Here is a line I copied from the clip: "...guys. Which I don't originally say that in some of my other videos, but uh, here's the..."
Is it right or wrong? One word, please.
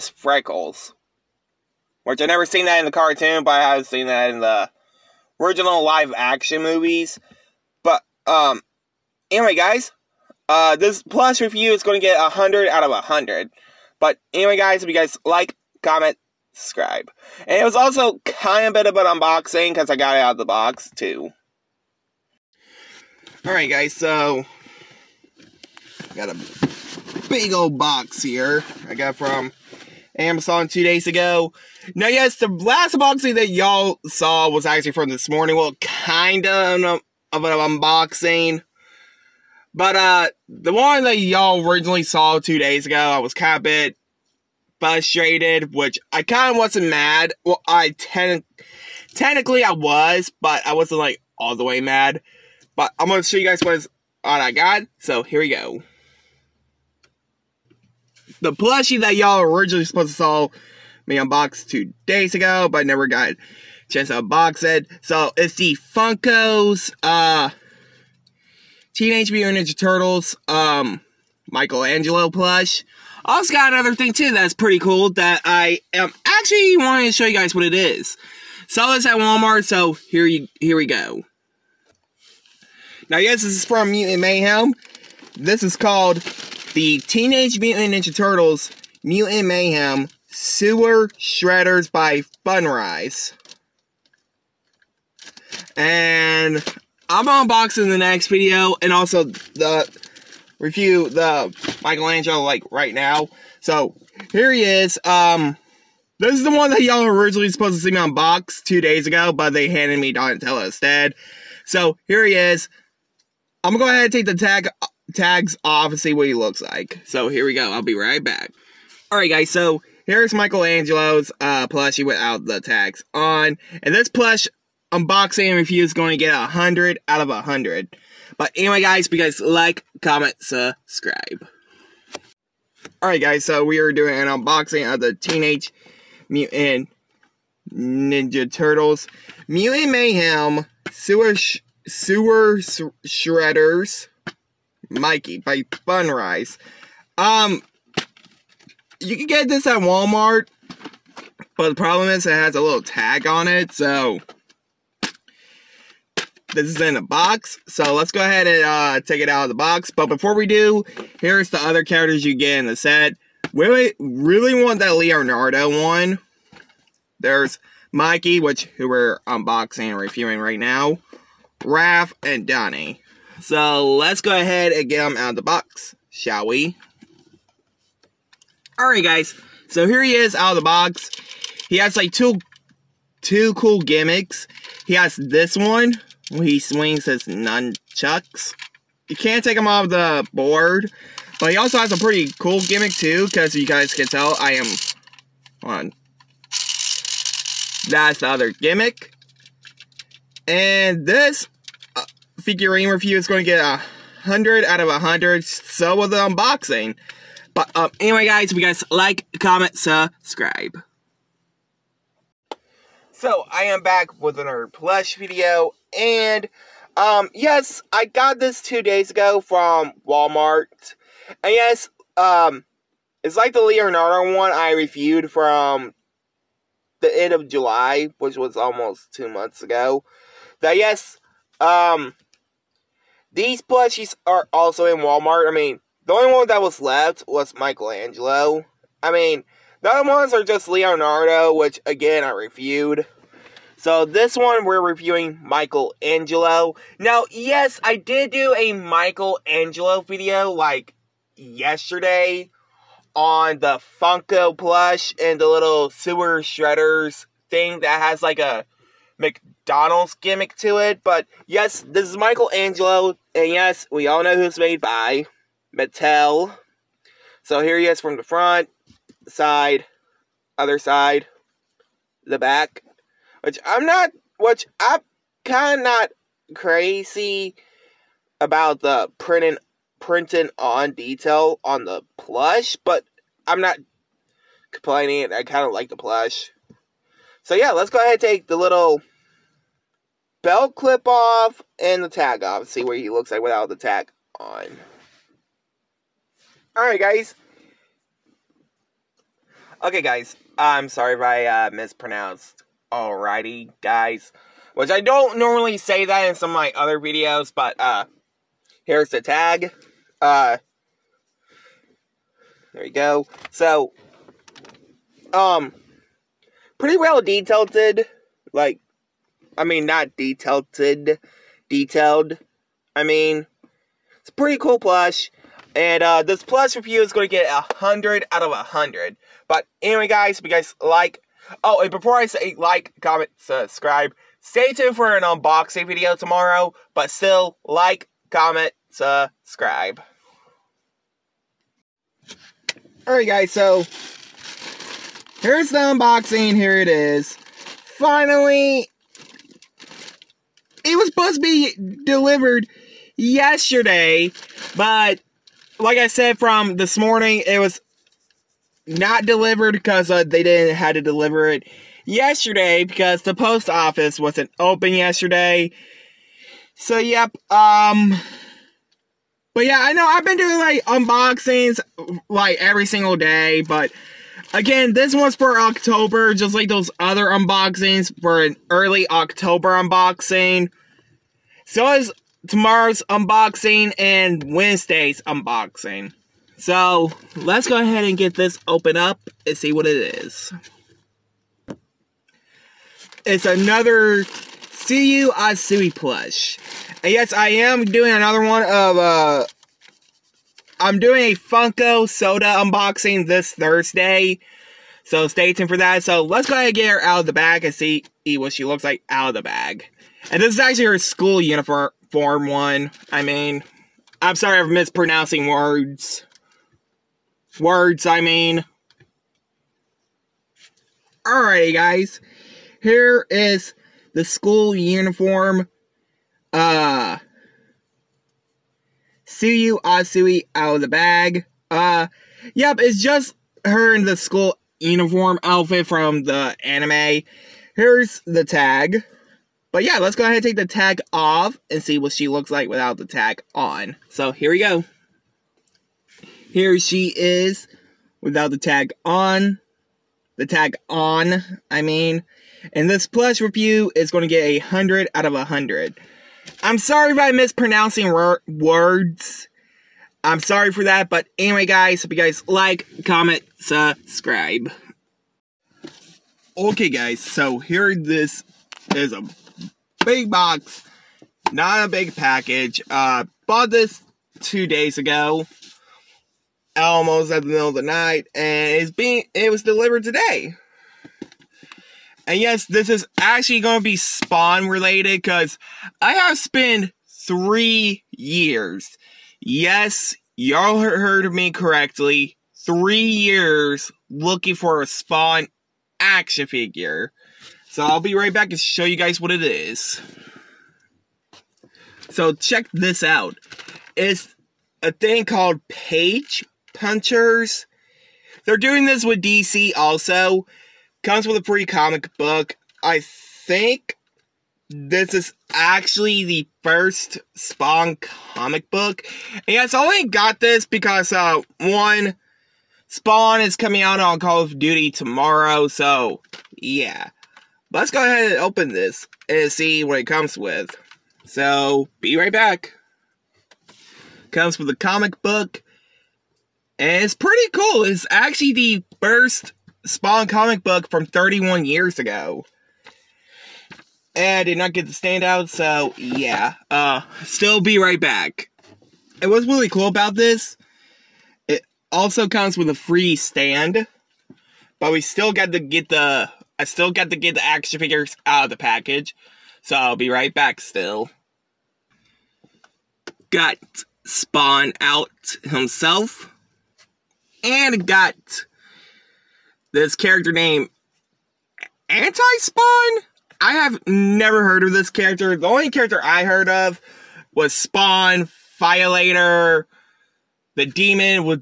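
wrong.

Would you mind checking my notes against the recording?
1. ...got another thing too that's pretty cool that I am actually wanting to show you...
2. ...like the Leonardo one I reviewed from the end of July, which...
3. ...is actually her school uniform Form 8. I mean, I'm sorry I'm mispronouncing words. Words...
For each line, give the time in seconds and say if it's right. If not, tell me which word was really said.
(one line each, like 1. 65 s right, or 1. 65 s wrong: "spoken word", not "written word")
1. 73 s right
2. 223 s right
3. 410 s wrong: "1", not "8".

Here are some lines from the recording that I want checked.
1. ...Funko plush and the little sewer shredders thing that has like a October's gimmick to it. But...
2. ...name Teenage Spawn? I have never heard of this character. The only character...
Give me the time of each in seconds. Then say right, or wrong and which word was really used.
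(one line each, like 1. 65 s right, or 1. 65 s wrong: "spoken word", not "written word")
1. 254 s wrong: "McDonald", not "October"
2. 570 s wrong: "Anti", not "Teenage".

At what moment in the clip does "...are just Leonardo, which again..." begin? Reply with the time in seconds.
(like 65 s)
240 s.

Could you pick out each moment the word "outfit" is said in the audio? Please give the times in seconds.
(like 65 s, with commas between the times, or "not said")
435 s.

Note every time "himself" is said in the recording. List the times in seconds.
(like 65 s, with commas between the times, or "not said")
565 s.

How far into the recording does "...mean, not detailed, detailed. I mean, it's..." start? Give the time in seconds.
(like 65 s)
319 s.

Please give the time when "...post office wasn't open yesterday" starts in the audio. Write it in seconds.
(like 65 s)
363 s.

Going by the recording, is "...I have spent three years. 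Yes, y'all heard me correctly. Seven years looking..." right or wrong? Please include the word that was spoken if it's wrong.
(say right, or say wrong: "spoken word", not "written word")
wrong: "Three", not "Seven".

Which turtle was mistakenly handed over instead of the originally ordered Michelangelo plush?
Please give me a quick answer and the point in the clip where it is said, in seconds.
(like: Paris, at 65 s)
Donatello, at 110 s.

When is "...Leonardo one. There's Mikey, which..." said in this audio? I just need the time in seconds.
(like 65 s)
164 s.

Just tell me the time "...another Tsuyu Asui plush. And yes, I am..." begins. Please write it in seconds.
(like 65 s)
393 s.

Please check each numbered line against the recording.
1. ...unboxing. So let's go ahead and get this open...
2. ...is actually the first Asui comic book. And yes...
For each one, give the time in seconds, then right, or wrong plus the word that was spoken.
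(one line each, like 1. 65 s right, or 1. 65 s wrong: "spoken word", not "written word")
1. 385 s right
2. 515 s wrong: "Spawn", not "Asui".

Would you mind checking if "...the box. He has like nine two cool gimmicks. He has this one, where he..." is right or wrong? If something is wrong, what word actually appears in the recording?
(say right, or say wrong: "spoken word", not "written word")
wrong: "two", not "nine".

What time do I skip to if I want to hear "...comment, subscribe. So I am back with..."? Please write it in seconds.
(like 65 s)
209 s.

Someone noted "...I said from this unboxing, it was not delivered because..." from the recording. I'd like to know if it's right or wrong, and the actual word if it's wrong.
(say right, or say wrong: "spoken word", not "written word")
wrong: "morning", not "unboxing".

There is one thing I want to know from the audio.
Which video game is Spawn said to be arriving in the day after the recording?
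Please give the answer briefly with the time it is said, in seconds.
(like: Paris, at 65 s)
Call of Duty, at 524 s.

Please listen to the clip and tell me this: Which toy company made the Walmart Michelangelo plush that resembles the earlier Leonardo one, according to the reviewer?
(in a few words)
Mattel.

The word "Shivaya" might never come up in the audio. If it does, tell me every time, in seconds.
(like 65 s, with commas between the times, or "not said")
not said.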